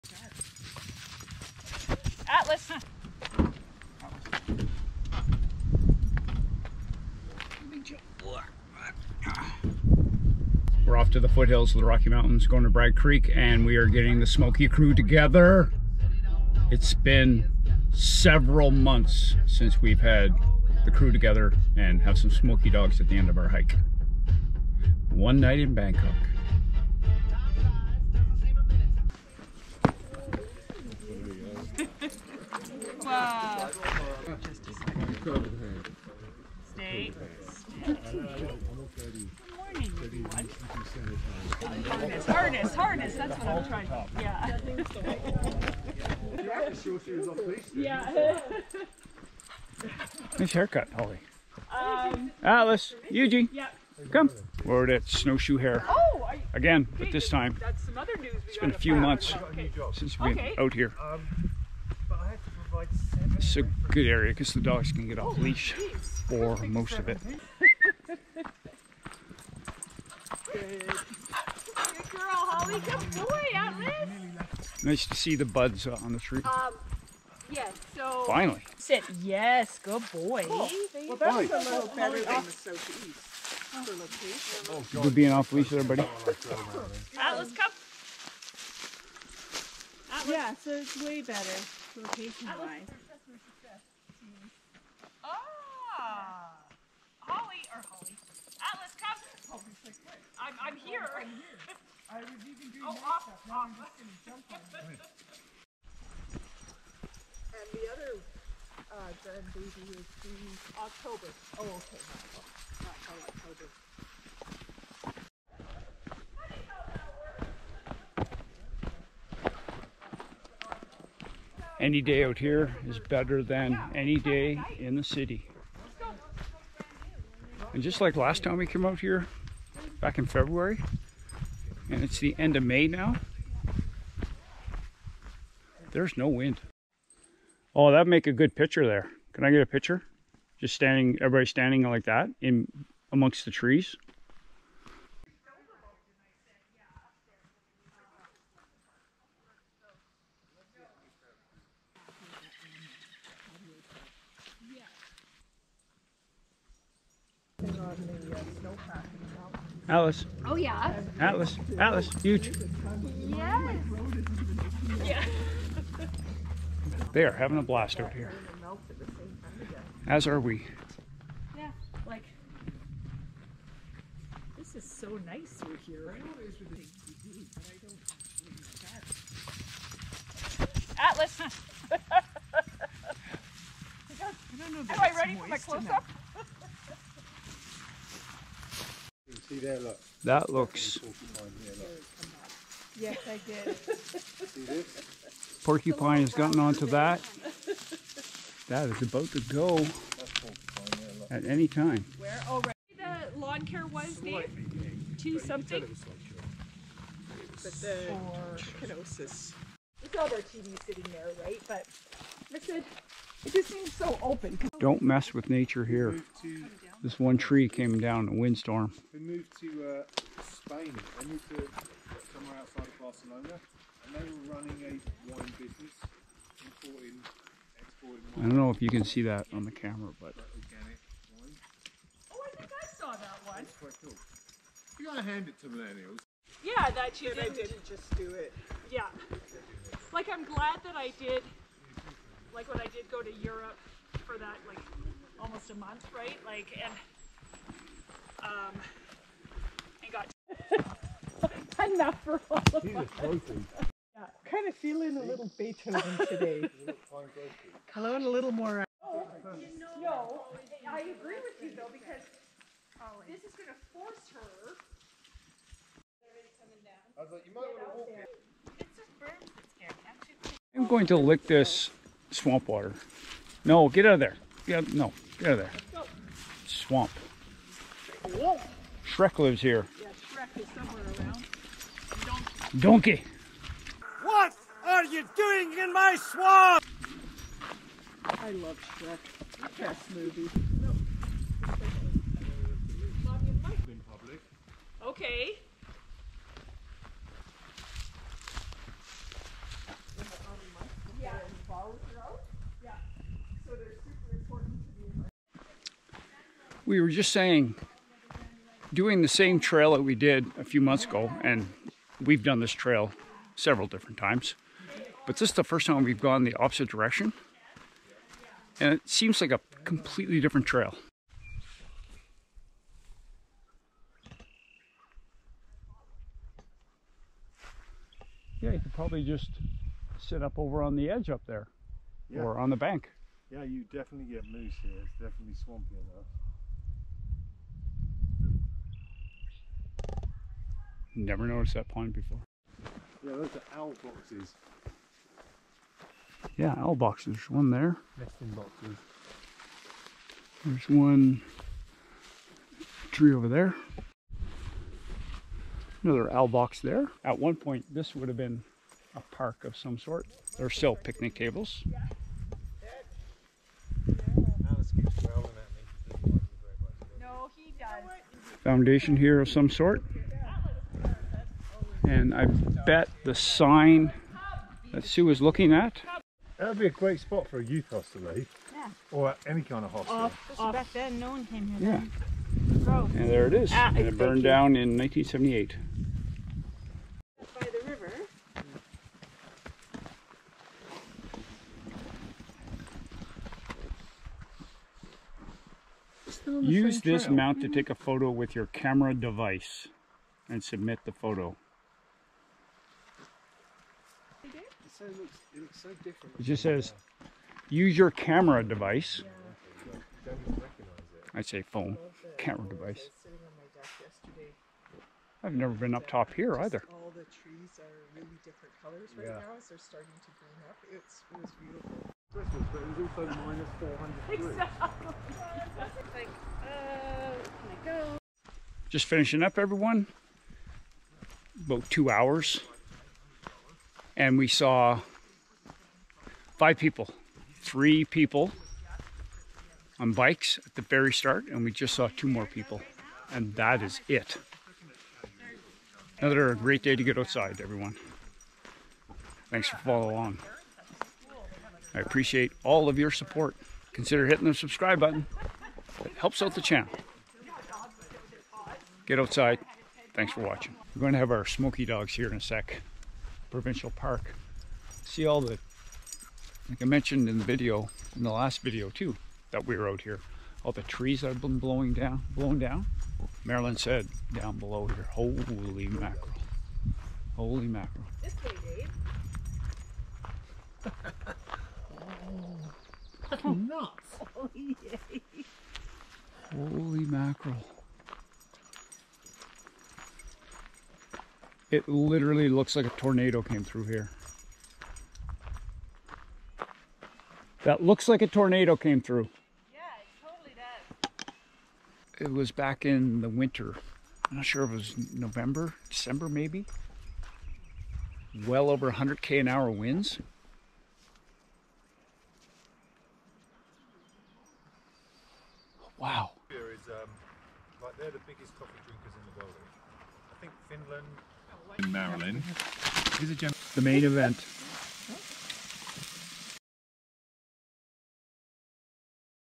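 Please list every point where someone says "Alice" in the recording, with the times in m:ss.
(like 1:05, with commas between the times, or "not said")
0:52, 2:39.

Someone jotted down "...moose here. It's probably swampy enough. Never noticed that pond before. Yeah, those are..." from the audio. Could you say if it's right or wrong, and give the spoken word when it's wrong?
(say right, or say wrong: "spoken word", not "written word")
wrong: "definitely", not "probably".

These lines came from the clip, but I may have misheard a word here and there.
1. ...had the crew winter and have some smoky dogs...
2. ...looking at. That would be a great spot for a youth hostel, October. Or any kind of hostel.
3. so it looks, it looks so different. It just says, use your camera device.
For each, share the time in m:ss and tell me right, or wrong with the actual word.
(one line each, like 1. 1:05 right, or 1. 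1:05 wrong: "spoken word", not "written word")
1. 0:20 wrong: "together", not "winter"
2. 6:15 wrong: "Yeah", not "October"
3. 6:45 right.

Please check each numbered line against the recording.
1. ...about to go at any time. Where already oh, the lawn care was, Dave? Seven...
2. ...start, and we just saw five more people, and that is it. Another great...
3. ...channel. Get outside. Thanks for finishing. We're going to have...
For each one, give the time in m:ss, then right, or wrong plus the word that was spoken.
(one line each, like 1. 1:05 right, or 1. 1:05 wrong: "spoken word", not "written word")
1. 3:19 wrong: "Two", not "Seven"
2. 7:21 wrong: "two", not "five"
3. 7:36 wrong: "watching", not "finishing".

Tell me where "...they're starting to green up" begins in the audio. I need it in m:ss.
6:59.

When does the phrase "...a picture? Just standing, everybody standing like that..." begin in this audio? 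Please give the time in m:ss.
2:19.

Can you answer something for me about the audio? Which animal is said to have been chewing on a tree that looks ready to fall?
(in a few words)
Porcupine.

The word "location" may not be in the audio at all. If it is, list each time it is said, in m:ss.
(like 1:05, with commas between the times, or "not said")
1:31.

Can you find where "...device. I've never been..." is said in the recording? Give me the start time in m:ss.
6:52.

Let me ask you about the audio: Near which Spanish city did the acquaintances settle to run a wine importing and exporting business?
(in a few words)
Barcelona.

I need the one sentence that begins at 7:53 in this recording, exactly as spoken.
Marilyn said down below here, holy mackerel, holy mackerel.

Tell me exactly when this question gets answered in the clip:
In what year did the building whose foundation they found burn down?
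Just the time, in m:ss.
6:24.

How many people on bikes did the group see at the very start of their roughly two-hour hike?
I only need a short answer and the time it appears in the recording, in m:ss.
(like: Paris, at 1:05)
3, at 7:17.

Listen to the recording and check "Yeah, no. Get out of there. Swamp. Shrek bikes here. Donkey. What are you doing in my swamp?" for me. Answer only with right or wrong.
wrong.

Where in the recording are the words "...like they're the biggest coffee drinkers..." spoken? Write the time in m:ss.
8:37.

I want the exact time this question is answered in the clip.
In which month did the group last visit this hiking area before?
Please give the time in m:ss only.
2:10.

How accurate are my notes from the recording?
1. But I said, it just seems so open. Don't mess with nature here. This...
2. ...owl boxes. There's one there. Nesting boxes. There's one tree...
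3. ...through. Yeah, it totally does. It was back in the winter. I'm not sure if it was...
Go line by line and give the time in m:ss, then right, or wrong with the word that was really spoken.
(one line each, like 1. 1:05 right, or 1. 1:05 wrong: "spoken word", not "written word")
1. 3:31 right
2. 5:46 right
3. 8:18 right.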